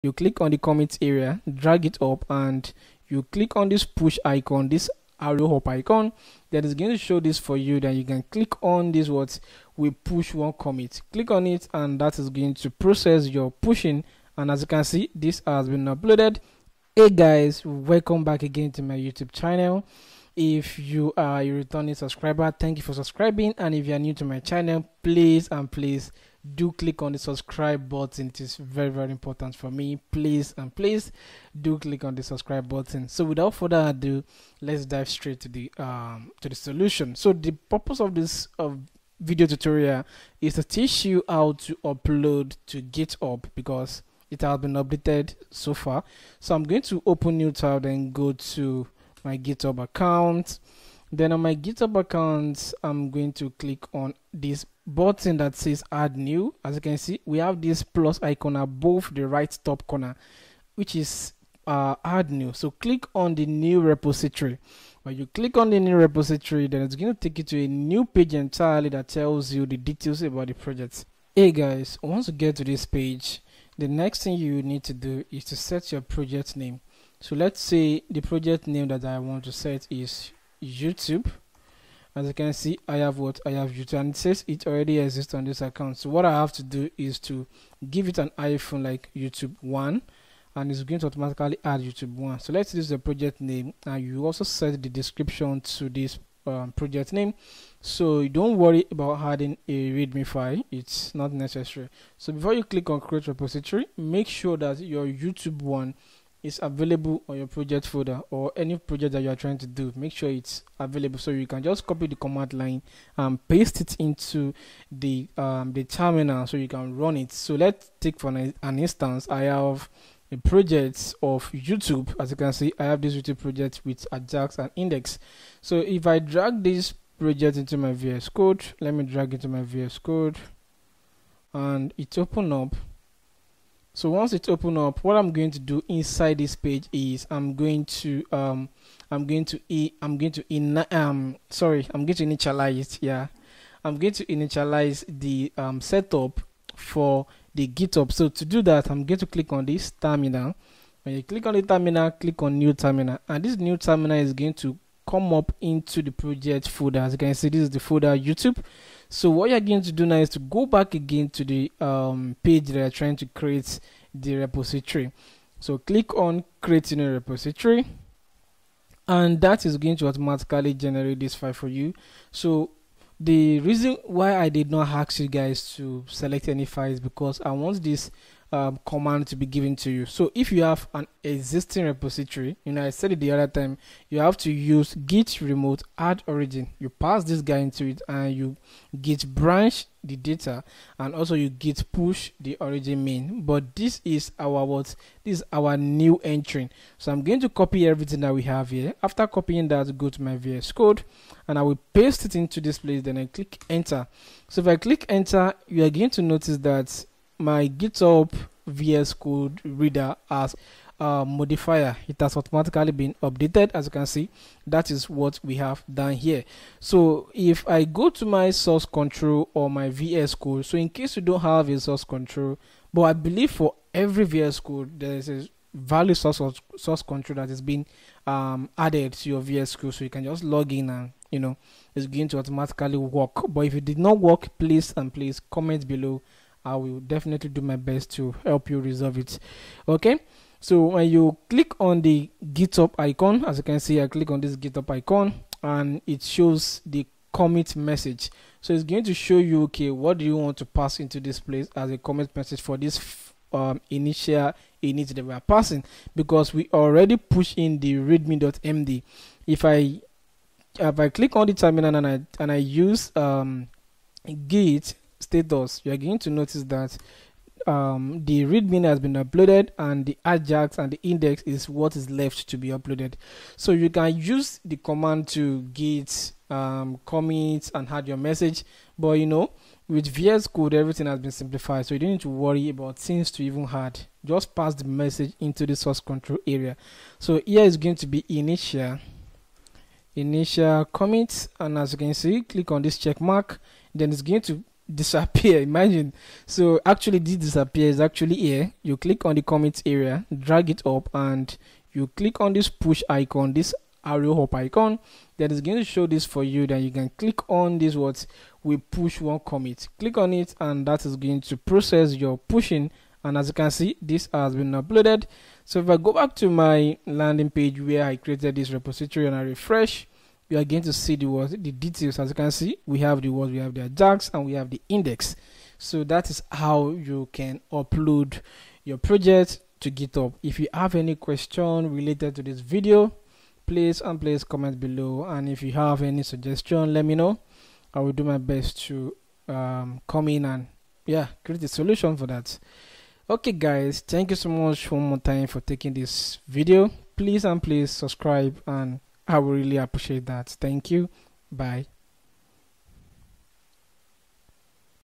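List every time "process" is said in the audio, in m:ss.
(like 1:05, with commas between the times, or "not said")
0:12, 5:11.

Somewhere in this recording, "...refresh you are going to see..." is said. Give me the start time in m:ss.
5:19.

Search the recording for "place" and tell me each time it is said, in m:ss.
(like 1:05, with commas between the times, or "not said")
3:22, 4:11.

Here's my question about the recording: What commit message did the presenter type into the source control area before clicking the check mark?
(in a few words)
initial commit.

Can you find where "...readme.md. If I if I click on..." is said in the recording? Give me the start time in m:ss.
4:17.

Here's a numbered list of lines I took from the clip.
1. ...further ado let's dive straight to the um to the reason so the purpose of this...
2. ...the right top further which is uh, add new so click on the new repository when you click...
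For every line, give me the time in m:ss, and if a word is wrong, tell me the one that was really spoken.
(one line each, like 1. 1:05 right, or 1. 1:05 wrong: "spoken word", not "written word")
1. 0:33 wrong: "solution", not "reason"
2. 0:59 wrong: "corner", not "further".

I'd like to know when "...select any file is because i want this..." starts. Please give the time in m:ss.
2:56.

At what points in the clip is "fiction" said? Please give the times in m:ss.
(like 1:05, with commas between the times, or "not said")
not said.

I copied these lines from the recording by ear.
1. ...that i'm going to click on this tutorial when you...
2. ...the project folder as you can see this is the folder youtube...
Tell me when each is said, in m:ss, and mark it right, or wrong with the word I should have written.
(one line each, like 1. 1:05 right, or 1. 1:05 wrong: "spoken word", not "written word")
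1. 2:28 wrong: "terminal", not "tutorial"
2. 2:36 right.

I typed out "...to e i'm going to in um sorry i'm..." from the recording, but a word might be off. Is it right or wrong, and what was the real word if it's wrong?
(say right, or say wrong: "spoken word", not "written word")
right.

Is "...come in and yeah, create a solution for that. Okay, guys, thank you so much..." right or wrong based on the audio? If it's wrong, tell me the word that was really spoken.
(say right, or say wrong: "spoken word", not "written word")
right.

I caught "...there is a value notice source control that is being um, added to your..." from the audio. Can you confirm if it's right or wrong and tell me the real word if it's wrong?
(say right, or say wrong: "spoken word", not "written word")
wrong: "source", not "notice".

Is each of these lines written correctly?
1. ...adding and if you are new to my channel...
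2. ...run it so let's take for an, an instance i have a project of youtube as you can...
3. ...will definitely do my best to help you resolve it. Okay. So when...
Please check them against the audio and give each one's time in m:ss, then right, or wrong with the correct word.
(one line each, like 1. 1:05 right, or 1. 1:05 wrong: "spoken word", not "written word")
1. 0:22 wrong: "subscribing", not "adding"
2. 1:56 right
3. 3:56 right.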